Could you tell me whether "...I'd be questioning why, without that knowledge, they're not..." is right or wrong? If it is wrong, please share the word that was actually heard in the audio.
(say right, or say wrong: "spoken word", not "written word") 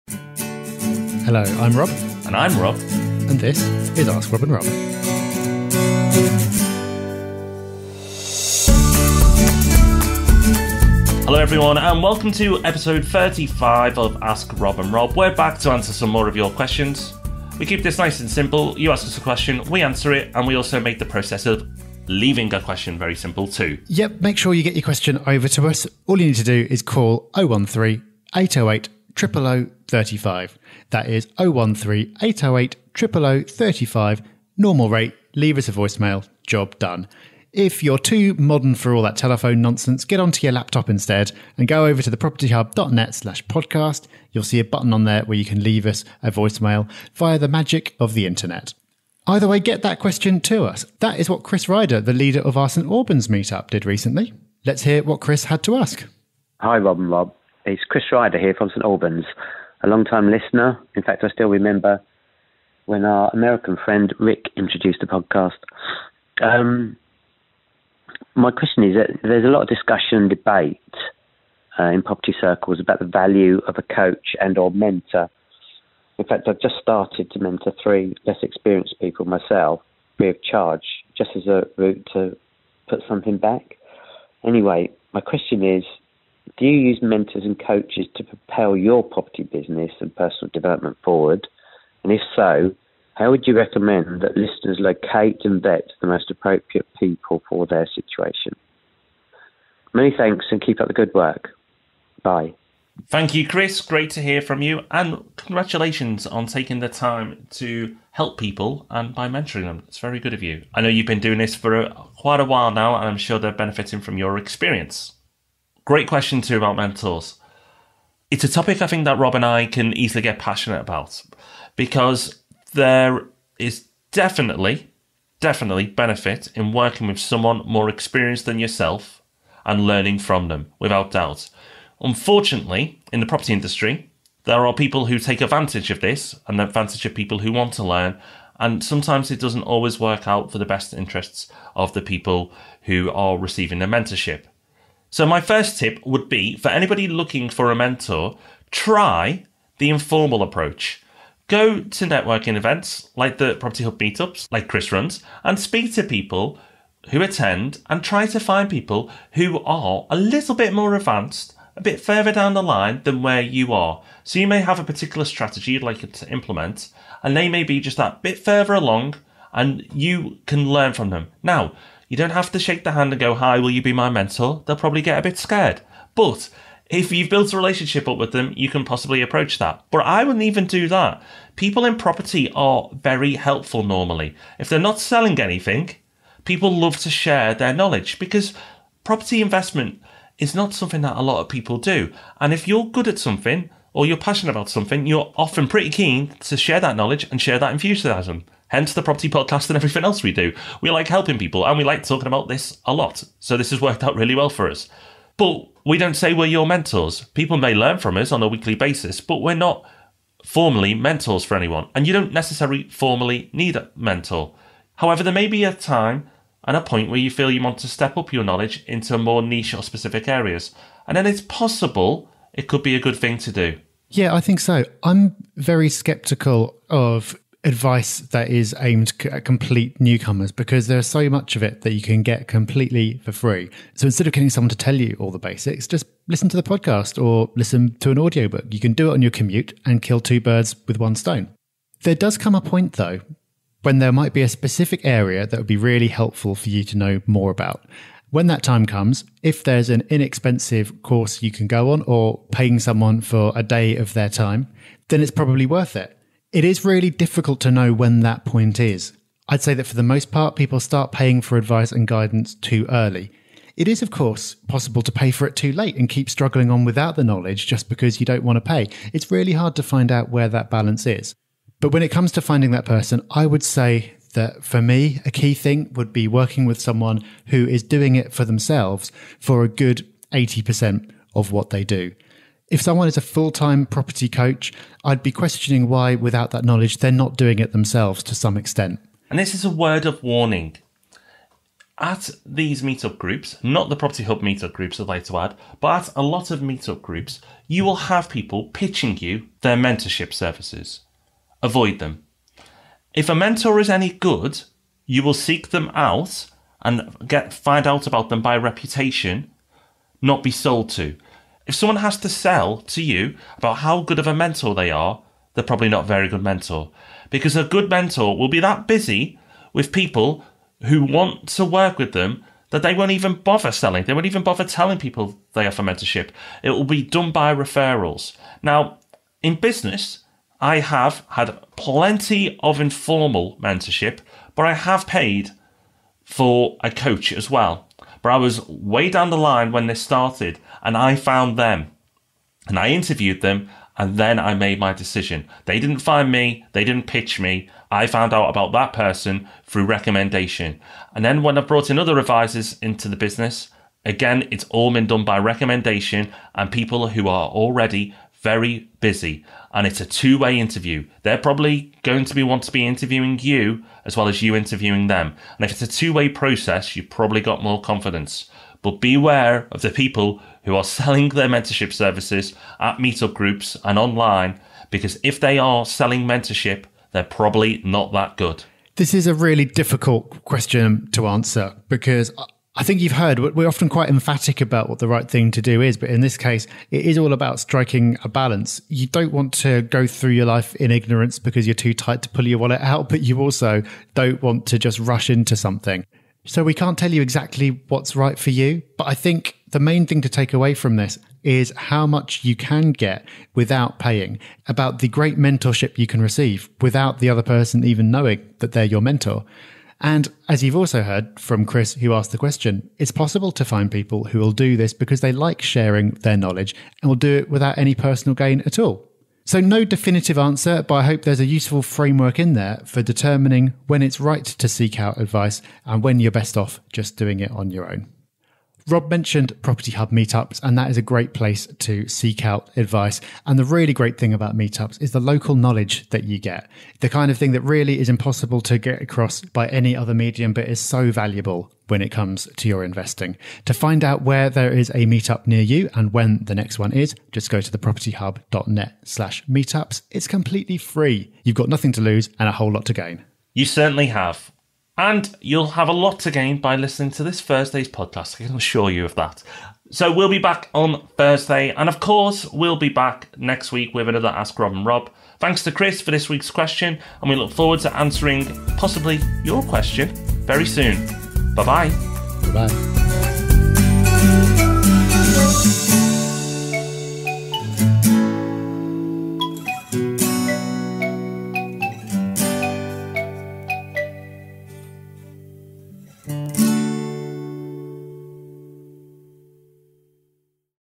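right.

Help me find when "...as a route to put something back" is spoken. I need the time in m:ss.
1:21.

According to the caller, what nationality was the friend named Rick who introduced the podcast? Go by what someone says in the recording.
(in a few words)
American.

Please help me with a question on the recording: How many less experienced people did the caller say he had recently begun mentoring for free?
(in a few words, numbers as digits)
3.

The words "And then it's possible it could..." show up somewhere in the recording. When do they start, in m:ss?
3:41.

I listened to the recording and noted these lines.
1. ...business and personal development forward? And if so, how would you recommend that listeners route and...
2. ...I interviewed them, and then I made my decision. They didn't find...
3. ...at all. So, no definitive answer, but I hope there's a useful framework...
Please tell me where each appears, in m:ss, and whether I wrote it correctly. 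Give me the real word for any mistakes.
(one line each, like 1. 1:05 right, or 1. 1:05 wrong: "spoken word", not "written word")
1. 1:29 wrong: "locate", not "route"
2. 5:42 right
3. 6:58 right.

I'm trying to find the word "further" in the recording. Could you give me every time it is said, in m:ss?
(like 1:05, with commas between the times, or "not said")
2:41, 2:48.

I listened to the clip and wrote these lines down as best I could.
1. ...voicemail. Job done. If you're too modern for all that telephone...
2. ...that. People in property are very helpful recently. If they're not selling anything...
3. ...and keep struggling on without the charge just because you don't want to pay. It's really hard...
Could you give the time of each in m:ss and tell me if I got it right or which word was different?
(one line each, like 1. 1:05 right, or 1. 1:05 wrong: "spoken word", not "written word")
1. 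0:35 right
2. 3:00 wrong: "normally", not "recently"
3. 4:25 wrong: "knowledge", not "charge".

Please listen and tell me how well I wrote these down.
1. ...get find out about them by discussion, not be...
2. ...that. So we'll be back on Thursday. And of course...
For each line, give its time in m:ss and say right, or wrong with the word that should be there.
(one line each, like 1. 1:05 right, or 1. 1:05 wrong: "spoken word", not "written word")
1. 5:07 wrong: "reputation", not "discussion"
2. 7:39 right.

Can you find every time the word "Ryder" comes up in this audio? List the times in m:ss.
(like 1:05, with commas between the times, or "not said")
0:51, 0:58.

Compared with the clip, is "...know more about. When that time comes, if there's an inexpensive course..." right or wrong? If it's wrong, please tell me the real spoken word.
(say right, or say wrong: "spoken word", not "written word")
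right.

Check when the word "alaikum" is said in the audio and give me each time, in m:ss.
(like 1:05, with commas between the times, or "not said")
not said.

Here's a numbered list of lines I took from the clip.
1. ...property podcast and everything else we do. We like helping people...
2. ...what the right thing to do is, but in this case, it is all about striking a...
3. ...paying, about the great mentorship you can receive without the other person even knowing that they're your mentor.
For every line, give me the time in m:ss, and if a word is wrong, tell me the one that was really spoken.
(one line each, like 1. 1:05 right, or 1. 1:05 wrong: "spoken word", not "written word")
1. 3:19 right
2. 6:24 right
3. 6:43 right.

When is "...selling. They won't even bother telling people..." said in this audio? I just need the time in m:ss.
5:23.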